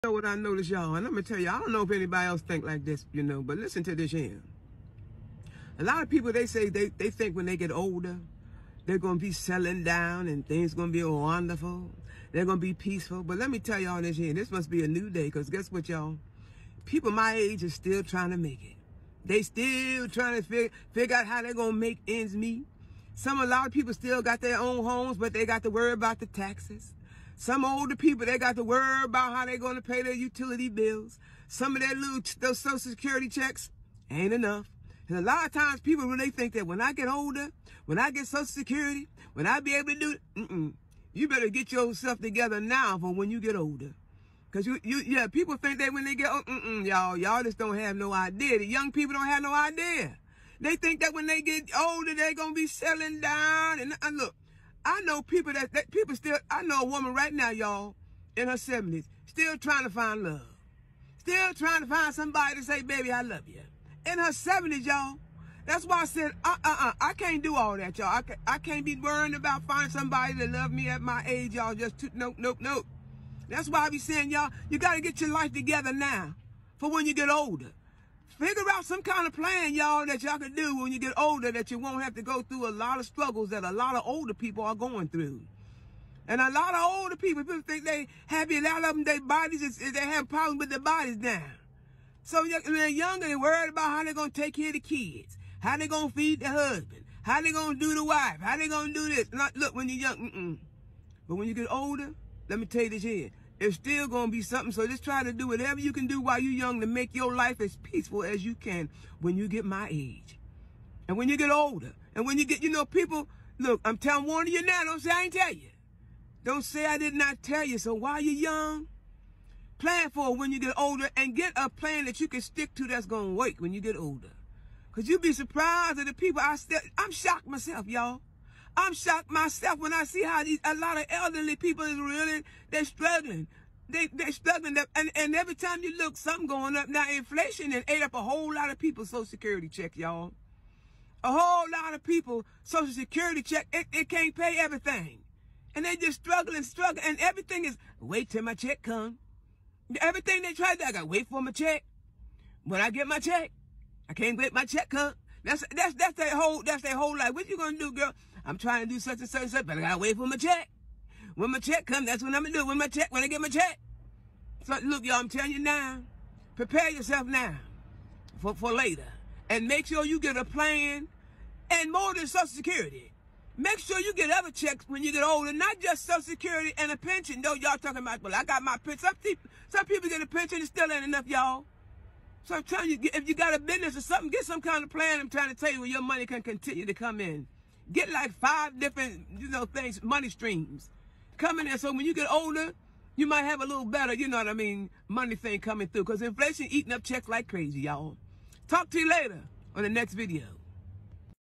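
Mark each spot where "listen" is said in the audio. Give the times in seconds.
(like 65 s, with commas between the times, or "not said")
3 s.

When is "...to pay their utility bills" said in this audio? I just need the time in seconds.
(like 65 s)
29 s.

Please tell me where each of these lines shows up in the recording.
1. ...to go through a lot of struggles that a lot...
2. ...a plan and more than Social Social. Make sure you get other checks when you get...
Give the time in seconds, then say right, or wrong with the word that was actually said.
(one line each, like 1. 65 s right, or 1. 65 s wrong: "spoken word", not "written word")
1. 82 s right
2. 170 s wrong: "Security", not "Social".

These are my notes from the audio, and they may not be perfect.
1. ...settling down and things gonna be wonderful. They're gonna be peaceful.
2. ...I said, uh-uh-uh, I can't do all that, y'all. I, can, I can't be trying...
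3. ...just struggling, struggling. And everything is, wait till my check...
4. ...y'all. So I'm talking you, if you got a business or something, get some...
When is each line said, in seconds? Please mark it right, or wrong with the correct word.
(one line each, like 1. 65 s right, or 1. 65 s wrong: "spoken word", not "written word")
1. 9 s right
2. 66 s wrong: "worrying", not "trying"
3. 145 s right
4. 181 s wrong: "telling", not "talking".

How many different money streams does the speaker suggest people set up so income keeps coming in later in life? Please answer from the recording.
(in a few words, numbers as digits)
5.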